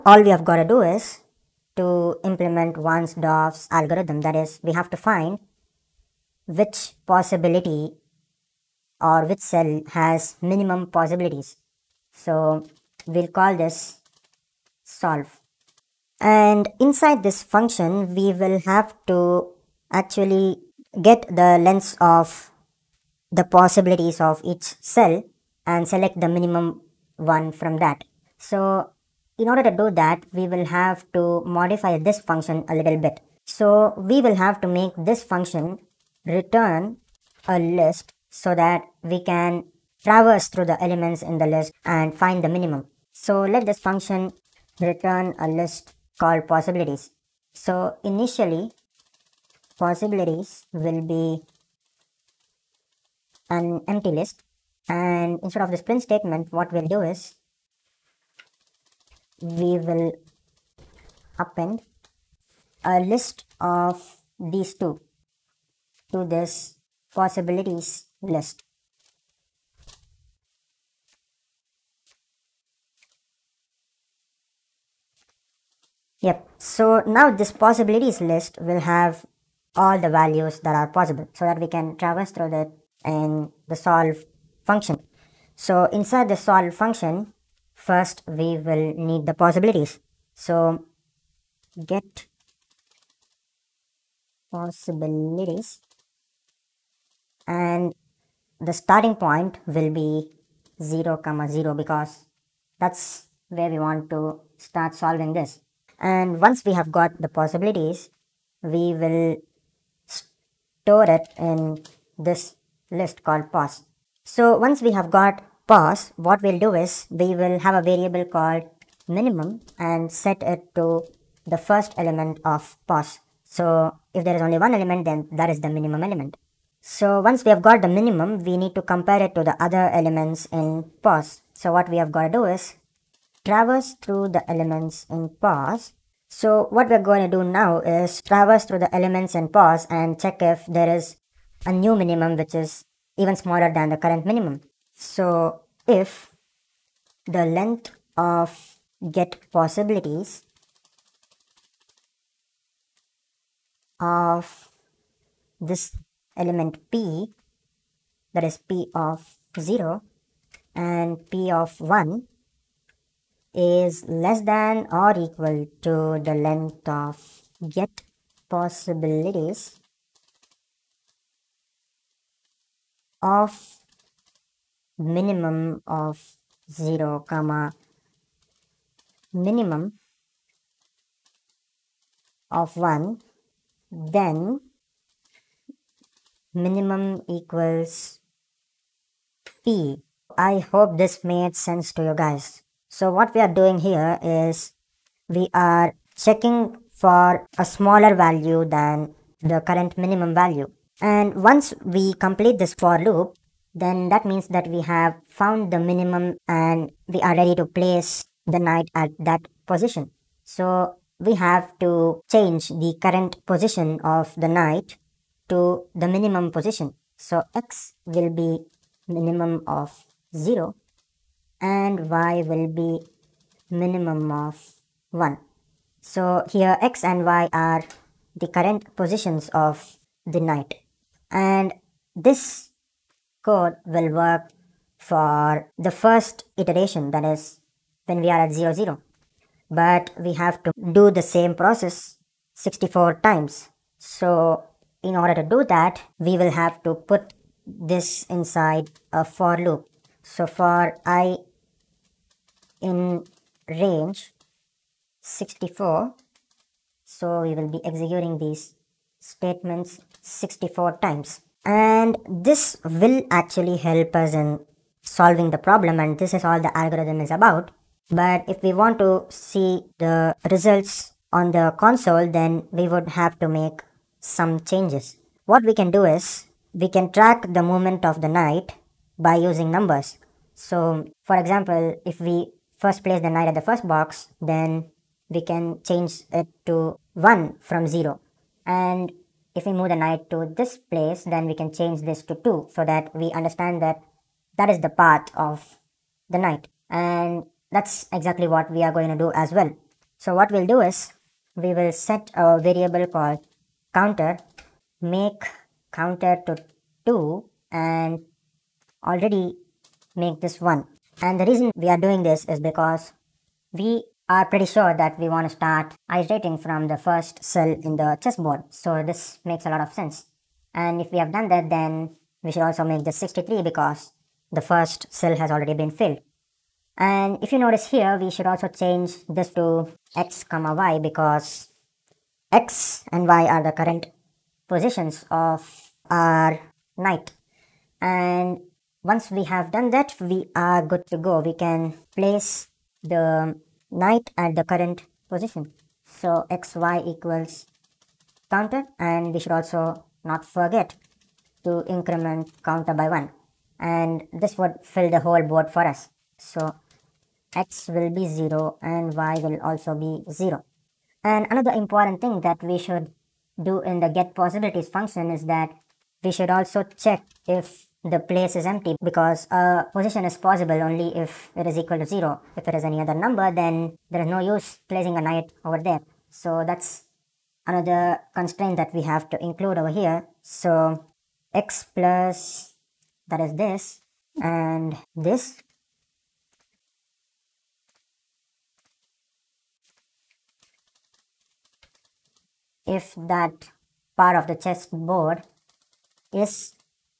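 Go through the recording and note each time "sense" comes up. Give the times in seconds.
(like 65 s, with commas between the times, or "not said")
191 s, 319 s.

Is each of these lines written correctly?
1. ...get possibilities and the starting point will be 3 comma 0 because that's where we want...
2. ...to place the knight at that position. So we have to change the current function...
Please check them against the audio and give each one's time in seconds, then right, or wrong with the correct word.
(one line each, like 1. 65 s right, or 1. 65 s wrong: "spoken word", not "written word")
1. 91 s wrong: "0", not "3"
2. 207 s wrong: "position", not "function".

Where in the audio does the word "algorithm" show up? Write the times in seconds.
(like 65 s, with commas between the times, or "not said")
3 s, 266 s.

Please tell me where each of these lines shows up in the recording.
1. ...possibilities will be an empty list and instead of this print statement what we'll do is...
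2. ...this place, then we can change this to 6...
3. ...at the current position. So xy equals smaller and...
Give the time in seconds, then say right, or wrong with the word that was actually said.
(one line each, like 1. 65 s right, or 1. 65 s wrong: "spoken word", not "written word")
1. 49 s right
2. 290 s wrong: "2", not "6"
3. 344 s wrong: "counter", not "smaller".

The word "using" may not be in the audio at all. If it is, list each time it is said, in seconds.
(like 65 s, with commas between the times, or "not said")
279 s.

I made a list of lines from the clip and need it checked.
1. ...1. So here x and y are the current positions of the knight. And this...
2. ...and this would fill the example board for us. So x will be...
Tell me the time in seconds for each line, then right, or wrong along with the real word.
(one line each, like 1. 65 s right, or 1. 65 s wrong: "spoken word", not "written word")
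1. 225 s right
2. 353 s wrong: "whole", not "example".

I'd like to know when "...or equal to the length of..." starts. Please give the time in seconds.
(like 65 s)
164 s.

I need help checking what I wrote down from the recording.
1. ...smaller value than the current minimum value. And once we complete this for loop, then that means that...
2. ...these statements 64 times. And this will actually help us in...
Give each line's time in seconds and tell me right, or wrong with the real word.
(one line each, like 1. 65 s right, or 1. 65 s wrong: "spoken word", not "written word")
1. 197 s right
2. 258 s right.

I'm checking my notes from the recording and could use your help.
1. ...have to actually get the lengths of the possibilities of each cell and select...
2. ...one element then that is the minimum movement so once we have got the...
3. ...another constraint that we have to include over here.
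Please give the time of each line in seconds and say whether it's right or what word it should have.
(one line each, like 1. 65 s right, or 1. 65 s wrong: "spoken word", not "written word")
1. 18 s right
2. 124 s wrong: "element", not "movement"
3. 377 s right.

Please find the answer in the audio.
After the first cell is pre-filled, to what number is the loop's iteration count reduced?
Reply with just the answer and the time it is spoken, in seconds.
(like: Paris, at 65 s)
63, at 323 s.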